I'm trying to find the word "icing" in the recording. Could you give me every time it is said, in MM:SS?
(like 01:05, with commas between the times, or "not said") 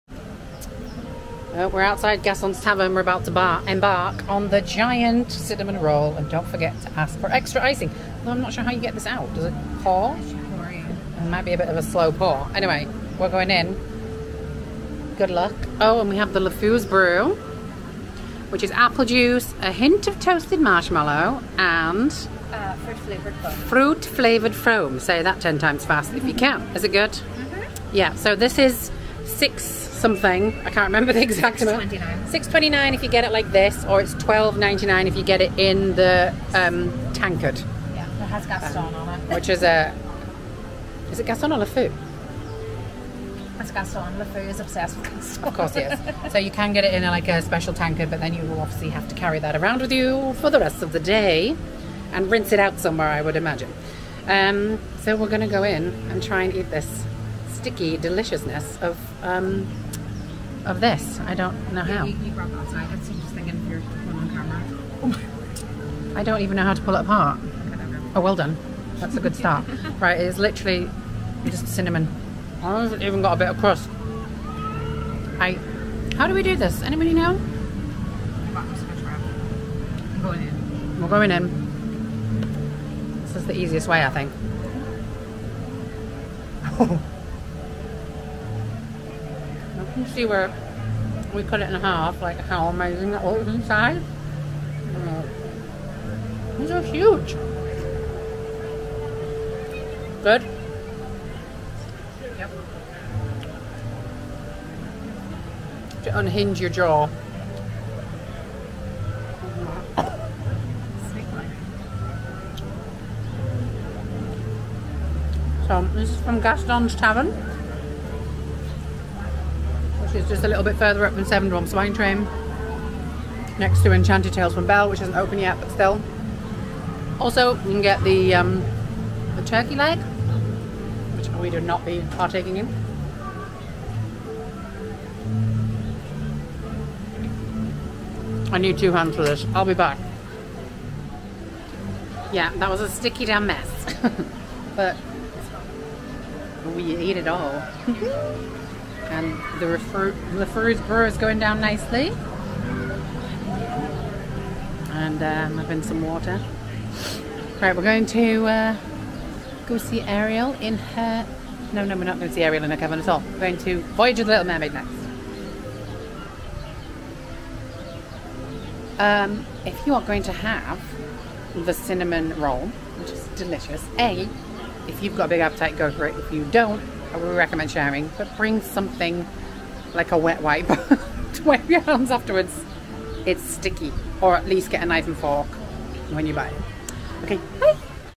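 00:07.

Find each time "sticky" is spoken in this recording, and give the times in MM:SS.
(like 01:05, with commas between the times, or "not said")
00:57, 02:22, 03:03.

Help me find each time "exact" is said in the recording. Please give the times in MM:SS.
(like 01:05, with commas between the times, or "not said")
00:31.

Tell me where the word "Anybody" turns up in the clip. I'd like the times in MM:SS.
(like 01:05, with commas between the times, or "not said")
01:16.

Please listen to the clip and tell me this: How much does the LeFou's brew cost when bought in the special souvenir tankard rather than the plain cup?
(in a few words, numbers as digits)
$12.99.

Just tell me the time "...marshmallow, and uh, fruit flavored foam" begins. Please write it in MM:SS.
00:20.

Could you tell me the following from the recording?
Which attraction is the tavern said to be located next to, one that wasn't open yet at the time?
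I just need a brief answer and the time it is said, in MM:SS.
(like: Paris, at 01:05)
Enchanted Tales from Belle, at 02:03.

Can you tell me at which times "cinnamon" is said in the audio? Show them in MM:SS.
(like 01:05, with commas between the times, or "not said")
00:05, 01:11, 02:51.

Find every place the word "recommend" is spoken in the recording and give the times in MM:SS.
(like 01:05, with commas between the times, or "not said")
02:57.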